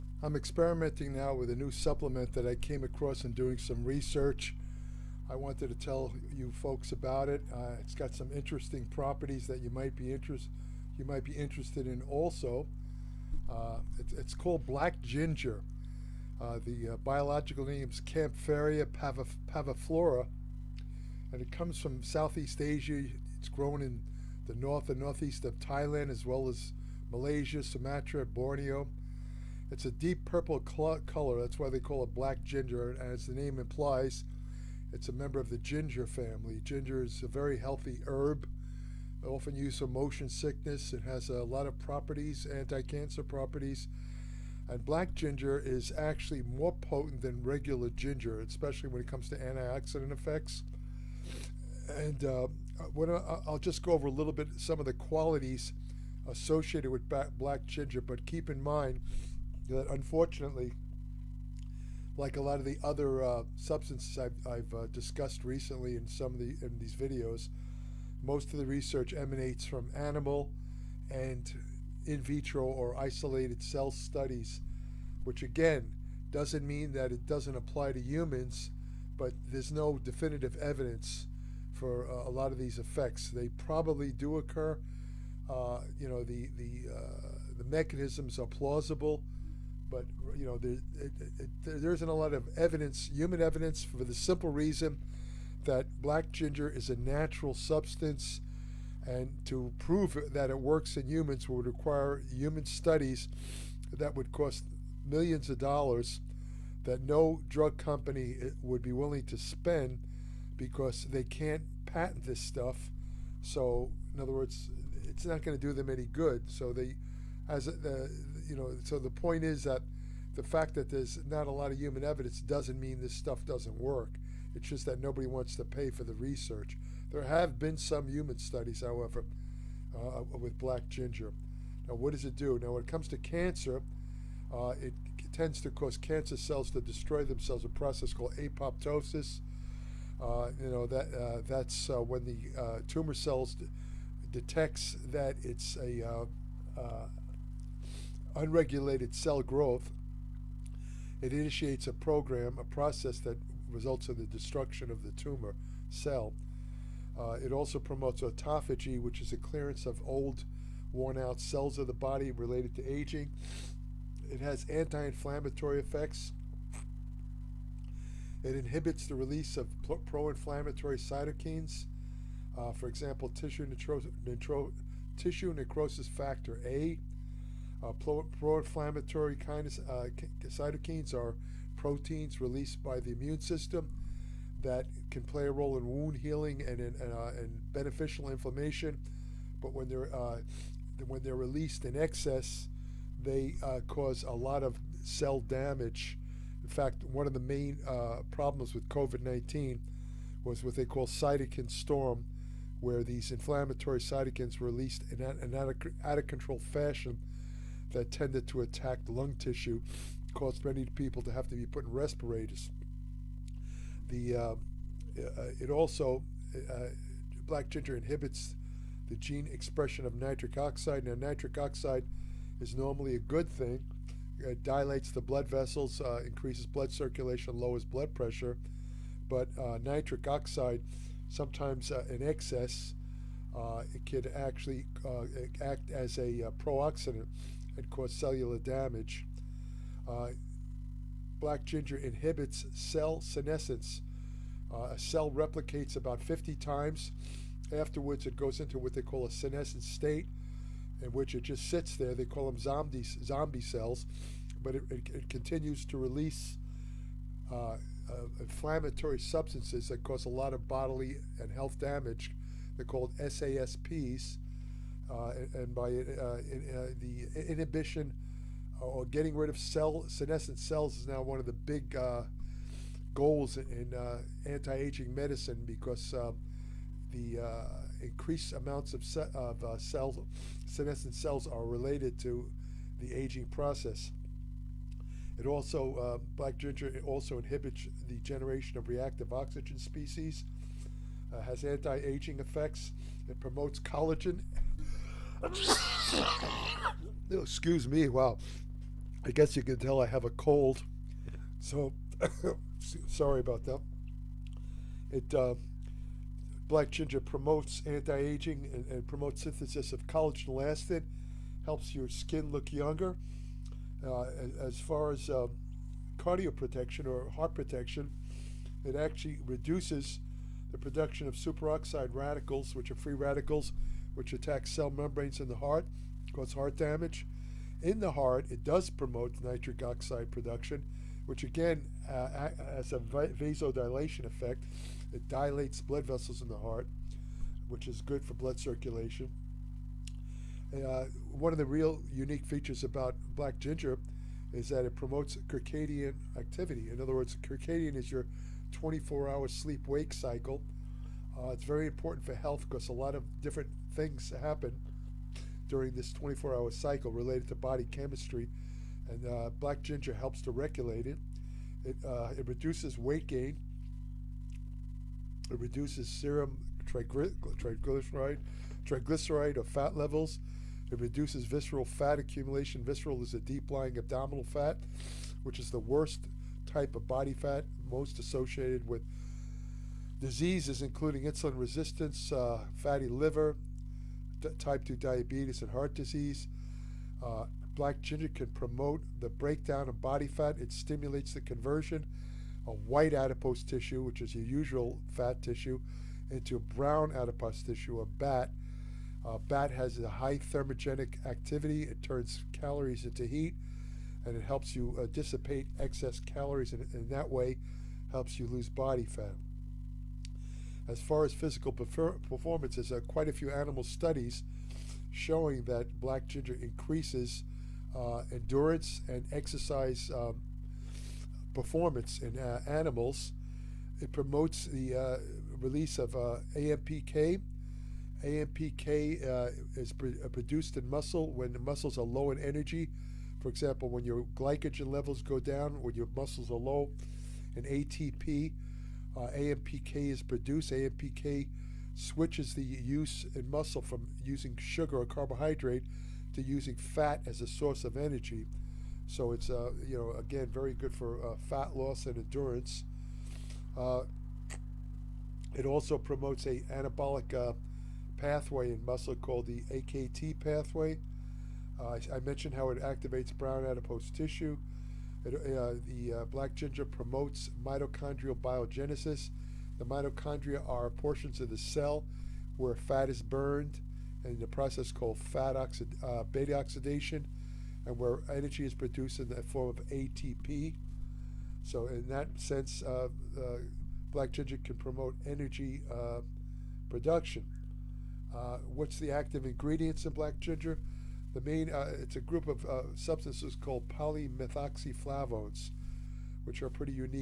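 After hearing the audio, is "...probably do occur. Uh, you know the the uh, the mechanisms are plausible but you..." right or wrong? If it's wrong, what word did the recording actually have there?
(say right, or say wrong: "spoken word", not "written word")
right.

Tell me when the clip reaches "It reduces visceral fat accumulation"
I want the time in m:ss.
6:10.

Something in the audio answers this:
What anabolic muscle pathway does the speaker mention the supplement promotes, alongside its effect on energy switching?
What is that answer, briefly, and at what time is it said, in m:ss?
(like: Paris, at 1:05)
AKT pathway, at 7:39.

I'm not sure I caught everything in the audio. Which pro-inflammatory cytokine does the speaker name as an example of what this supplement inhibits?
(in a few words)
tissue necrosis factor A.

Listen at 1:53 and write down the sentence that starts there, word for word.
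So, in other words, it's not going to do them any good.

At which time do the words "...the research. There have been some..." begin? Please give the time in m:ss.
2:06.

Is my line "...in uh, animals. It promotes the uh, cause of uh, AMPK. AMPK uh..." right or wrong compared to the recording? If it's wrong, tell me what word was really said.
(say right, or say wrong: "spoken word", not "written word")
wrong: "release", not "cause".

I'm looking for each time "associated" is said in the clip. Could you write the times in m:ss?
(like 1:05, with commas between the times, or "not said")
0:56, 6:18.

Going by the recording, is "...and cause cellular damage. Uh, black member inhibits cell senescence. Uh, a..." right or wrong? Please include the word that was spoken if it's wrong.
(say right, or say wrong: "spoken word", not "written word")
wrong: "ginger", not "member".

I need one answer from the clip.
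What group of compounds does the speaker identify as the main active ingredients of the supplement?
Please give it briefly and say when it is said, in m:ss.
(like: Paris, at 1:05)
polymethoxyflavones, at 8:13.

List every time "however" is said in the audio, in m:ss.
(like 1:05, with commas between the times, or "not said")
2:08.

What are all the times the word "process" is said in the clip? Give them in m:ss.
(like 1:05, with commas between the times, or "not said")
2:17, 2:32, 4:43, 7:54.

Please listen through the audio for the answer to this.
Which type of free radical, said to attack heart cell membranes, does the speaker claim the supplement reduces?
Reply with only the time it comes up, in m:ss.
5:21.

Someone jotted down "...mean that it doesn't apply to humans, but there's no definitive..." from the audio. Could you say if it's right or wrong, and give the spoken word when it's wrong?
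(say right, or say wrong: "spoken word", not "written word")
right.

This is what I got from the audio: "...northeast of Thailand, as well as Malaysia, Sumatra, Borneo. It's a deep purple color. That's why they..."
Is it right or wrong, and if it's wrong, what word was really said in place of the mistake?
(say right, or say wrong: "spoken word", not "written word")
right.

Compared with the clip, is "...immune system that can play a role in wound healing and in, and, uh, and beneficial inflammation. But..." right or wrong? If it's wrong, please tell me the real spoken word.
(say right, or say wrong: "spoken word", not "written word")
right.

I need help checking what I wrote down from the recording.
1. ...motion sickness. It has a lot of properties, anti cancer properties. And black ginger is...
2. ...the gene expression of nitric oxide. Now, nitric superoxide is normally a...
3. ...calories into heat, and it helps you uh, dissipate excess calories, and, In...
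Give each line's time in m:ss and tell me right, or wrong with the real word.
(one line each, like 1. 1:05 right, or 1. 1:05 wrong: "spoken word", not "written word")
1. 0:39 right
2. 3:39 wrong: "oxide", not "superoxide"
3. 6:42 right.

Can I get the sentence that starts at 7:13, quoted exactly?
For example, when your glycogen levels go down, when your muscles are low, and ATP, uh, AMPK is produced.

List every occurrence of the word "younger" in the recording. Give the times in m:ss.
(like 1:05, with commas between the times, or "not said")
5:12.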